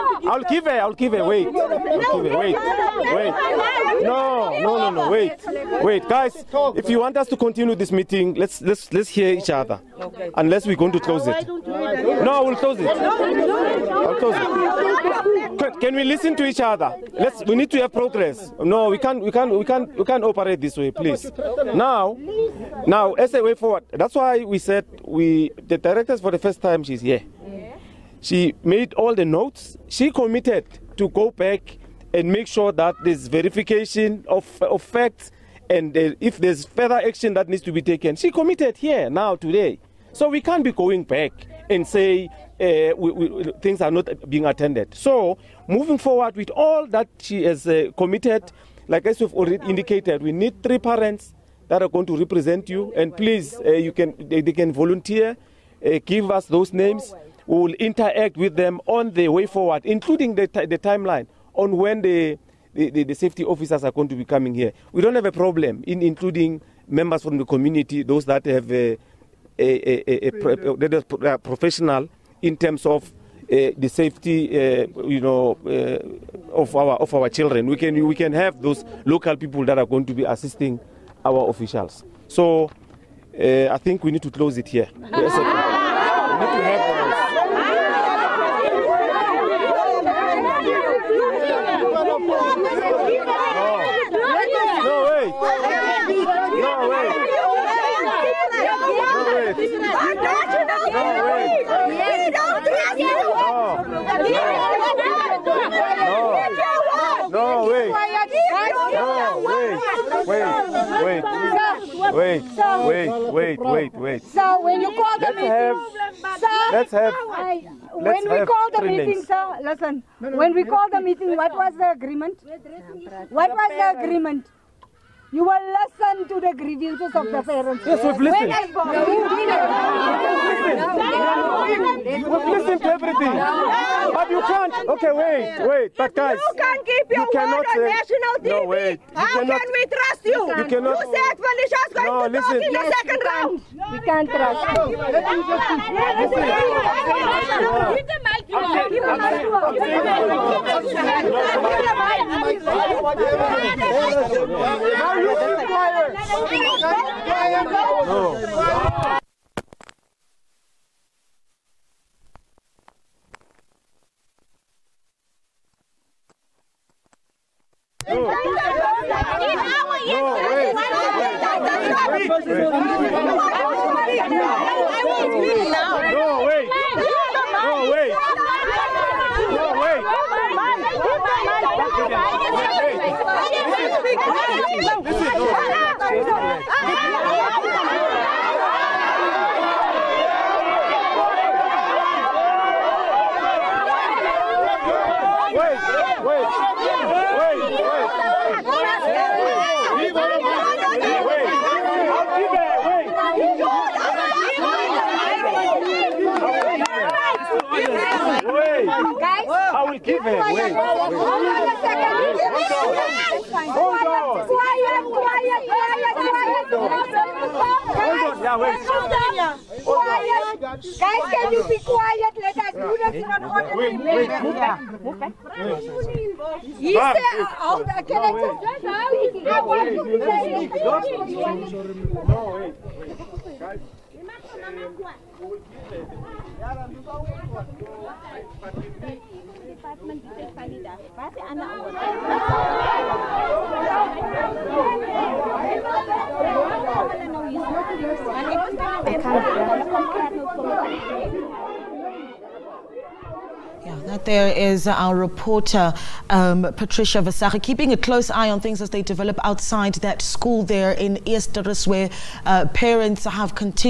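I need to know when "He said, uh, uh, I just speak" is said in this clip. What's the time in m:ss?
3:46.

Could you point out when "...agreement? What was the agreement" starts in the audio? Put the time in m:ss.
2:01.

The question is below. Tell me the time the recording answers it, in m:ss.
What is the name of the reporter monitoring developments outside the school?
4:16.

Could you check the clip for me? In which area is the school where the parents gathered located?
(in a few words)
Eersterust.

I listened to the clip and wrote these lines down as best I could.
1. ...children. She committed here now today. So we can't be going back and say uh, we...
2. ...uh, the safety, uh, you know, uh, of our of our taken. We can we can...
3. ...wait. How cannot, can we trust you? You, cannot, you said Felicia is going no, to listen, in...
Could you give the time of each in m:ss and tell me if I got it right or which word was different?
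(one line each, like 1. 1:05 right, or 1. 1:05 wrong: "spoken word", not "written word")
1. 0:37 wrong: "taken", not "children"
2. 1:13 wrong: "children", not "taken"
3. 2:18 right.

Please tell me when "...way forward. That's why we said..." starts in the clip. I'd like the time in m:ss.
0:23.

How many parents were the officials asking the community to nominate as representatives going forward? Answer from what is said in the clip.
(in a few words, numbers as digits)
3.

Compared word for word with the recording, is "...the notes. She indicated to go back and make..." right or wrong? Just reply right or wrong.
wrong.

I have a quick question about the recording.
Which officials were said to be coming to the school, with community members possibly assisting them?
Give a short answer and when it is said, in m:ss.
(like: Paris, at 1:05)
safety officers, at 1:03.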